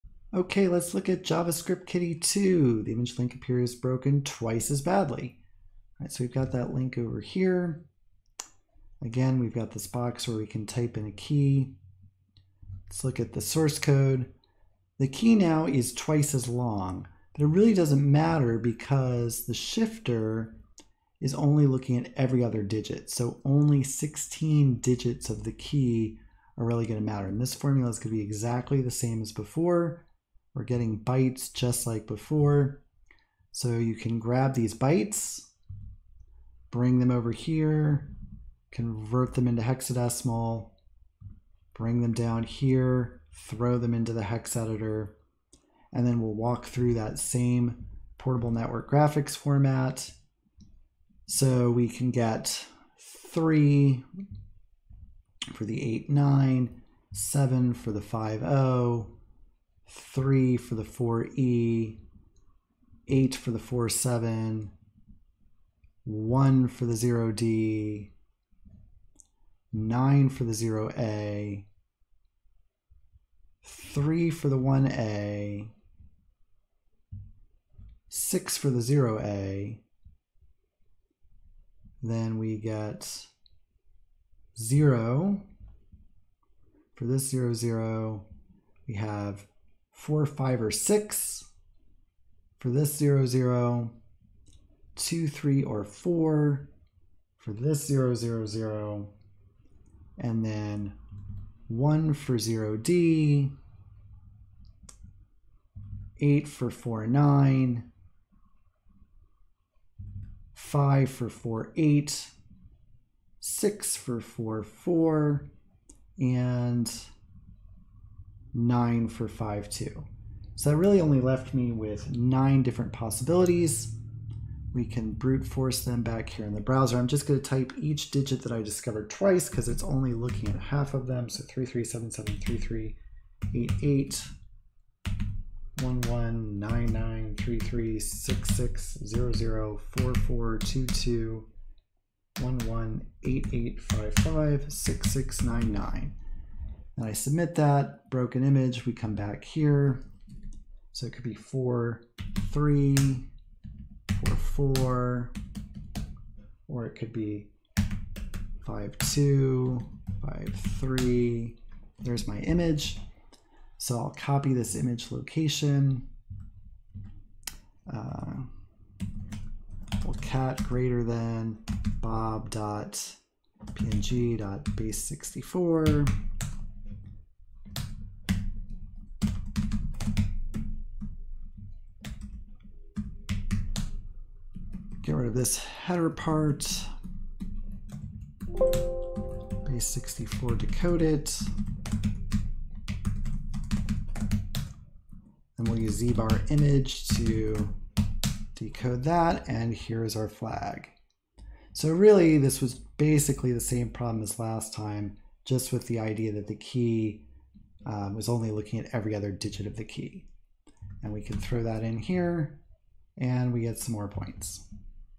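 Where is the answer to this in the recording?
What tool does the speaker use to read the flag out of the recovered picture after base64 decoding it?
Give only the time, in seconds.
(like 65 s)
196 s.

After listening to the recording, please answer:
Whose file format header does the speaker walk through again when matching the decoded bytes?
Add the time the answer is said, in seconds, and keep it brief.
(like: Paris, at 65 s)
Portable Network Graphics, at 48 s.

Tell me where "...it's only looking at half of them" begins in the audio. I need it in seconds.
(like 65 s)
129 s.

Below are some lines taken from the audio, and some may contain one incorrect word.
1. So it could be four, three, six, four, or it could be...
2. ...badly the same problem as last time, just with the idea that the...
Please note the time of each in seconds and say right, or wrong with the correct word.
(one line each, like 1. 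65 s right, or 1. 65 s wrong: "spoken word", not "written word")
1. 150 s wrong: "four", not "six"
2. 202 s wrong: "basically", not "badly".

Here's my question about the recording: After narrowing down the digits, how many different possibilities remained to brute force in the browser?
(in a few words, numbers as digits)
9.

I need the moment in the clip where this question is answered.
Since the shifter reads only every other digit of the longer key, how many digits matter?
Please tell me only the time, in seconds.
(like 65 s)
23 s.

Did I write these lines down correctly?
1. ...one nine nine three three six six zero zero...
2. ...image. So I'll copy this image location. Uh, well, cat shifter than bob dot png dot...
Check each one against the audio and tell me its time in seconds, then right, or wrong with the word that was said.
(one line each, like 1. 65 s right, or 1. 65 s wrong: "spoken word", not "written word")
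1. 136 s right
2. 162 s wrong: "greater", not "shifter".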